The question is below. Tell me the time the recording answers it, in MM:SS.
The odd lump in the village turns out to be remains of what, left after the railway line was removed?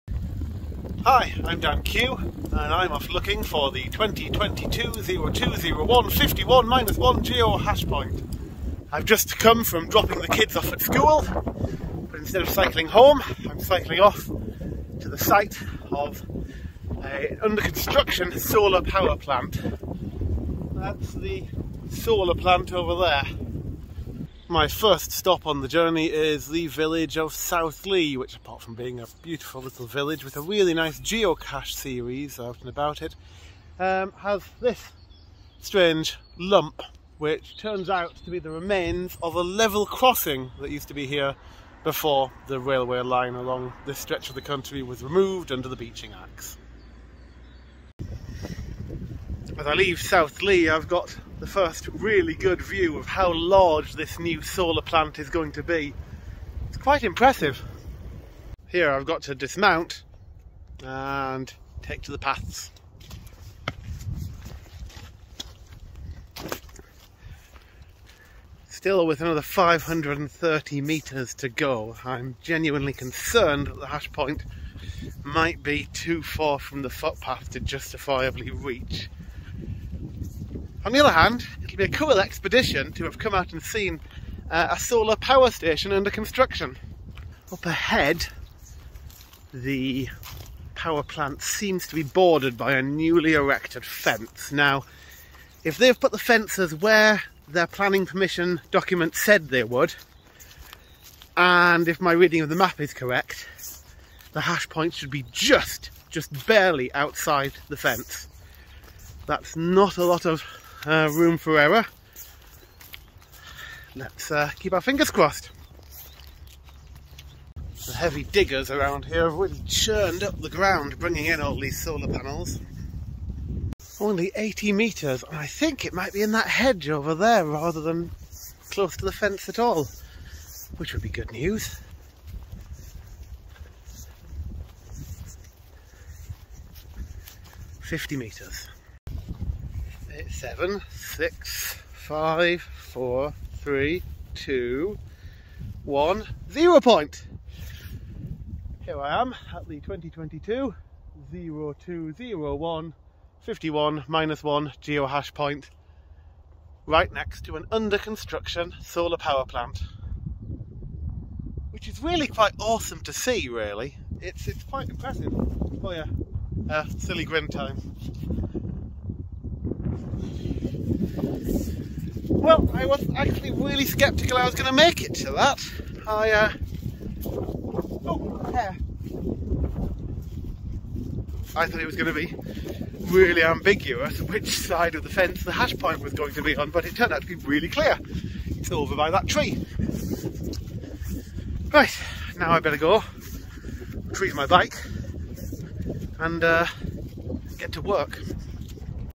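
00:39.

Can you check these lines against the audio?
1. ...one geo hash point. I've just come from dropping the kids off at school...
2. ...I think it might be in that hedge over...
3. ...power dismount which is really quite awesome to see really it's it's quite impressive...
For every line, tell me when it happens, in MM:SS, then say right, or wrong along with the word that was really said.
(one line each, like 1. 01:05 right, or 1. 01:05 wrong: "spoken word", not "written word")
1. 00:06 right
2. 02:05 right
3. 02:39 wrong: "plant", not "dismount".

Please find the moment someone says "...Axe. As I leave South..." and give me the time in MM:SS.
00:46.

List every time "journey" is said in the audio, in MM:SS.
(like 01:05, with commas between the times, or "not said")
00:25.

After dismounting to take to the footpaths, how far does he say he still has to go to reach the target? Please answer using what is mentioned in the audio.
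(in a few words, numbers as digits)
530 metres.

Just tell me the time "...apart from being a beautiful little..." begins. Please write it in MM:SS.
00:28.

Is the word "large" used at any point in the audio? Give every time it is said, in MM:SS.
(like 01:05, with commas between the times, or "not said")
00:53.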